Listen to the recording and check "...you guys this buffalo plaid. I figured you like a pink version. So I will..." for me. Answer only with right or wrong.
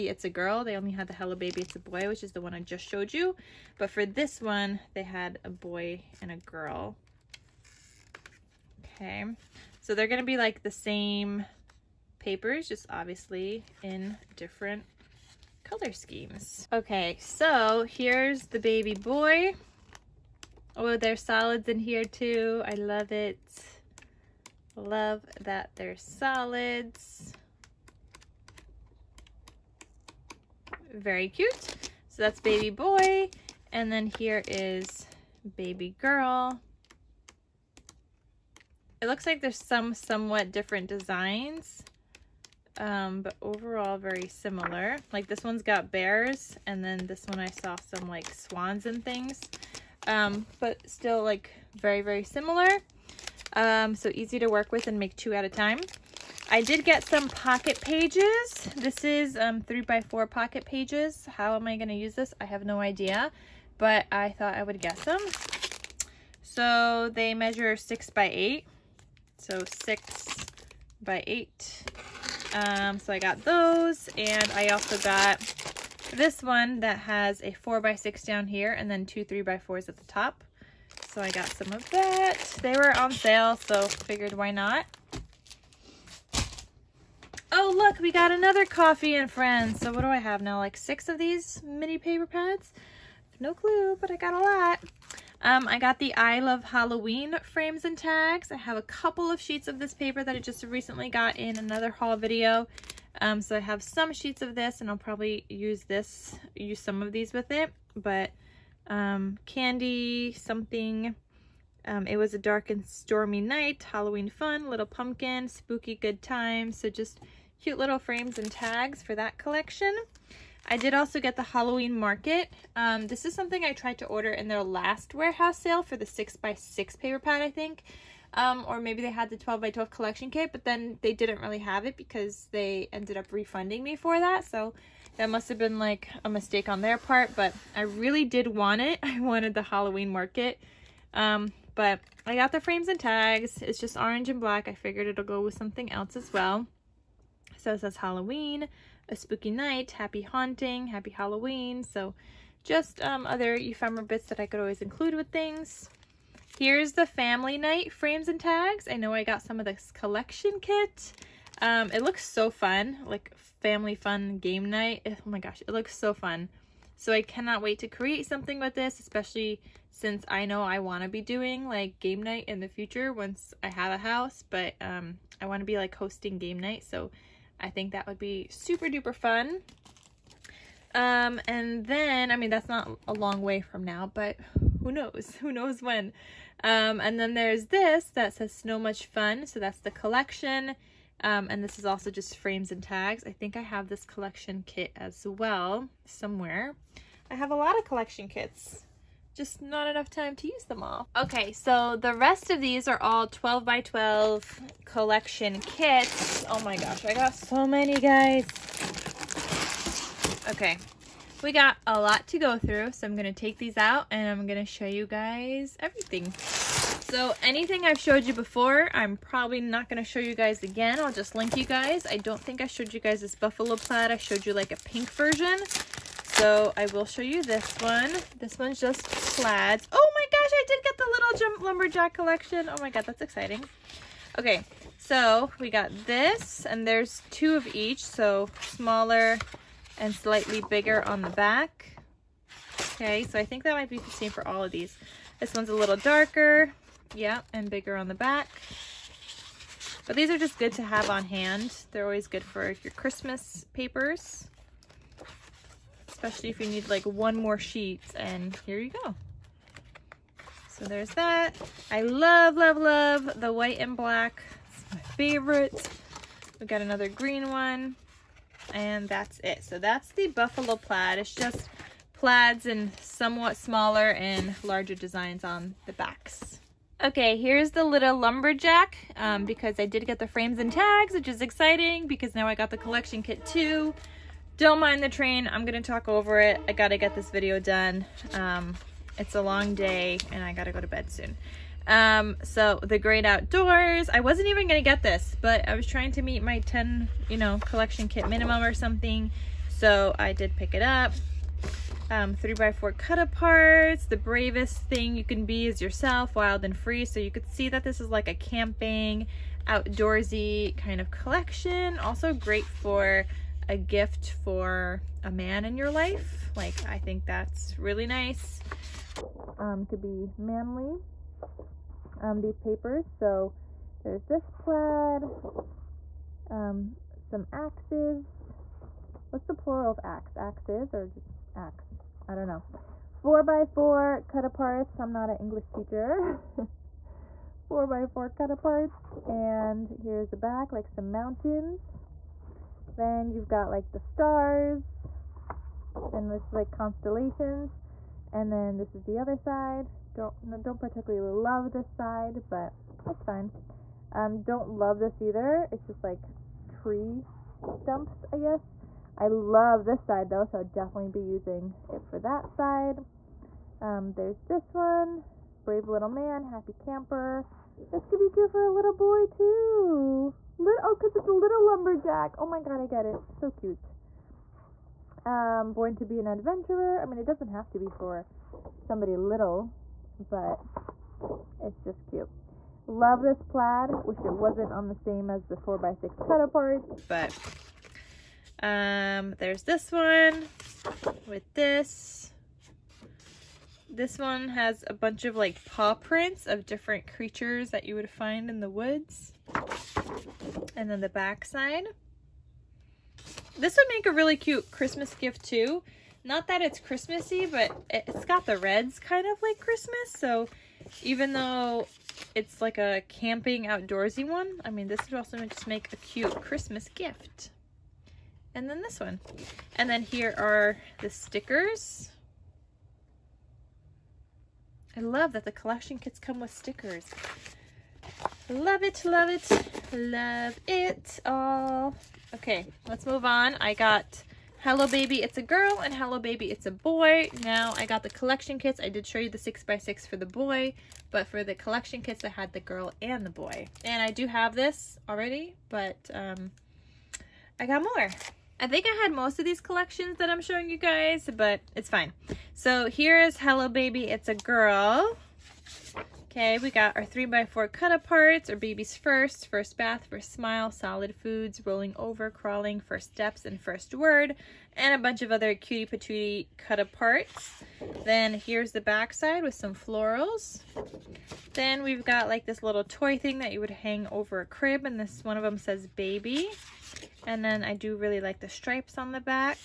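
wrong.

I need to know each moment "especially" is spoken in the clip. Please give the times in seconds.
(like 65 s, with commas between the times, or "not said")
168 s, 256 s.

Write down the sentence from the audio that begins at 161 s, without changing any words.
Um, it looks so fun, like family fun game night.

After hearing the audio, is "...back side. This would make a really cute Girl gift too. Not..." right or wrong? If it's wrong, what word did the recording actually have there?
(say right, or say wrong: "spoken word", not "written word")
wrong: "Christmas", not "Girl".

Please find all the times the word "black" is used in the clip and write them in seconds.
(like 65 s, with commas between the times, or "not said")
144 s, 263 s.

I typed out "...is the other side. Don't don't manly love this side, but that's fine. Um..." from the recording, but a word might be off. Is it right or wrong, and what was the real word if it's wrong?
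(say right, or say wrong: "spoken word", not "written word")
wrong: "particularly", not "manly".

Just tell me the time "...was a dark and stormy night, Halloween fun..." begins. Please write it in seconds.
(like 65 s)
112 s.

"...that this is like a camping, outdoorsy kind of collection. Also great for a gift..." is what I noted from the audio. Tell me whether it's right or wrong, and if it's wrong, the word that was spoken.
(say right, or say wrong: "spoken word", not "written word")
right.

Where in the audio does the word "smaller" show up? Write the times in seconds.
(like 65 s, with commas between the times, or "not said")
238 s, 273 s.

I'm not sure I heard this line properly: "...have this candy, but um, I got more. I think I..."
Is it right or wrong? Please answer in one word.
wrong.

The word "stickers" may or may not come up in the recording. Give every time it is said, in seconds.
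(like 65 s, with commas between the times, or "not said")
421 s, 426 s.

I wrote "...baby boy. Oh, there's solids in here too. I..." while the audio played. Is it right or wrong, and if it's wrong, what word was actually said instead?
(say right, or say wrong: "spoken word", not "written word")
right.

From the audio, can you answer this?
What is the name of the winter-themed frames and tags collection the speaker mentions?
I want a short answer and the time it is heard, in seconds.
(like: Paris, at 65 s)
Snow Much Fun, at 188 s.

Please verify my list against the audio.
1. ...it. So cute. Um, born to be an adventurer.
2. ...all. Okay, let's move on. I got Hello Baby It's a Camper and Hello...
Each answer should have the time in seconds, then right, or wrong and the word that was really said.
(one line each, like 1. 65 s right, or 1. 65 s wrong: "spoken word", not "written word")
1. 373 s right
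2. 431 s wrong: "Girl", not "Camper".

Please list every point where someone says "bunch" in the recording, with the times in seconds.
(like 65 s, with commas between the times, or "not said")
394 s, 464 s.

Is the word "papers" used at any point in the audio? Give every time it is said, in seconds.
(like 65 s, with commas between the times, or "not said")
12 s, 91 s, 99 s, 126 s, 253 s, 322 s.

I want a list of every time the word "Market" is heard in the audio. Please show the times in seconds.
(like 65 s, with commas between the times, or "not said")
121 s, 140 s.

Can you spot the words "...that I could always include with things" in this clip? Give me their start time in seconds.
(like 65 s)
154 s.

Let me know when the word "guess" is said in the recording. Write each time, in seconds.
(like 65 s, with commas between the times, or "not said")
64 s, 358 s.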